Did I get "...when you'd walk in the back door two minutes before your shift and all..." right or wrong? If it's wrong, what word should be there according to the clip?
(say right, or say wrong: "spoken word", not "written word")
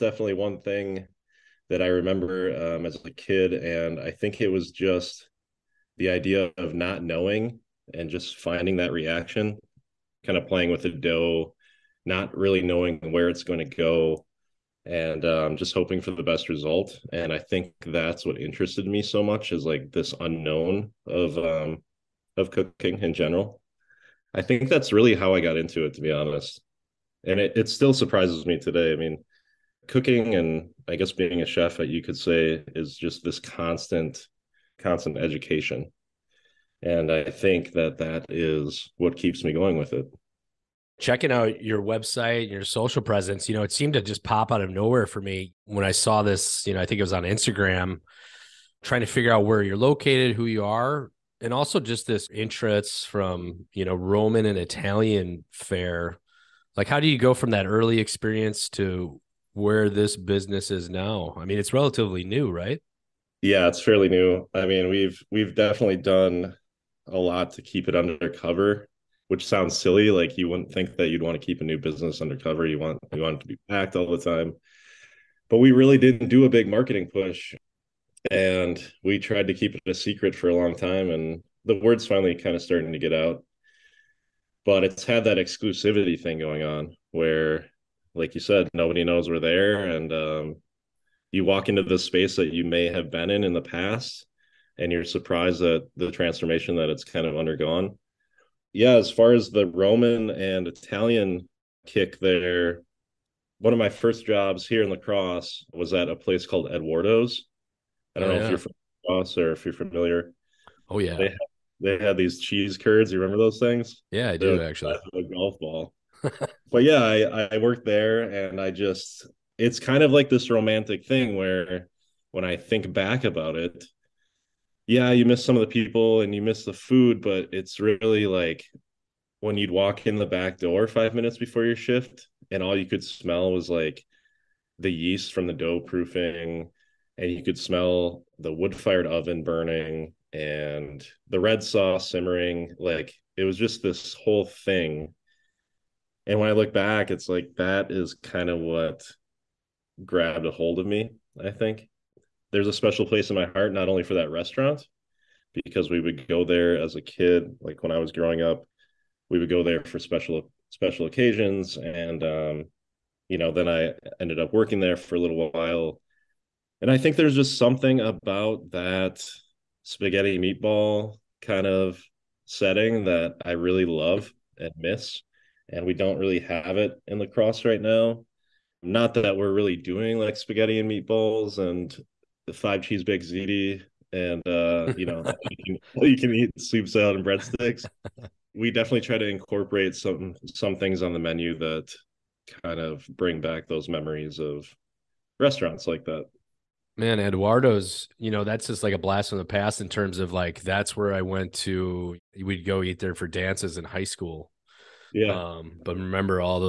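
wrong: "five", not "two".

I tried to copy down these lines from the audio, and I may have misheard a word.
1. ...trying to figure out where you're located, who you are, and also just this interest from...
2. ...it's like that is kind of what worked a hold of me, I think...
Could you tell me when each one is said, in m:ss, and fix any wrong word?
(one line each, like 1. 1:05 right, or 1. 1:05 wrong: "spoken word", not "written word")
1. 0:48 right
2. 2:27 wrong: "grabbed", not "worked".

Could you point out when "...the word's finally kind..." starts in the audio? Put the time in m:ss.
1:21.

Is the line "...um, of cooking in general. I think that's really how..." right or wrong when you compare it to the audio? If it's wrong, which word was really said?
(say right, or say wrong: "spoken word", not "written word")
right.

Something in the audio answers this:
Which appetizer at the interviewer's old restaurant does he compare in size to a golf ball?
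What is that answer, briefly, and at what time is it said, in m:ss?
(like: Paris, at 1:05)
Cheese curds, at 1:52.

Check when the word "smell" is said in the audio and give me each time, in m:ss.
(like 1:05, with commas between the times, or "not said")
2:13, 2:17.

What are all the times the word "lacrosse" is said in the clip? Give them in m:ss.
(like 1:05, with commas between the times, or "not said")
1:44, 1:49, 2:57.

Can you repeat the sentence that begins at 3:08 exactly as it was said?
we definitely try to incorporate some some things on the menu that kind of bring back those memories of restaurants like that.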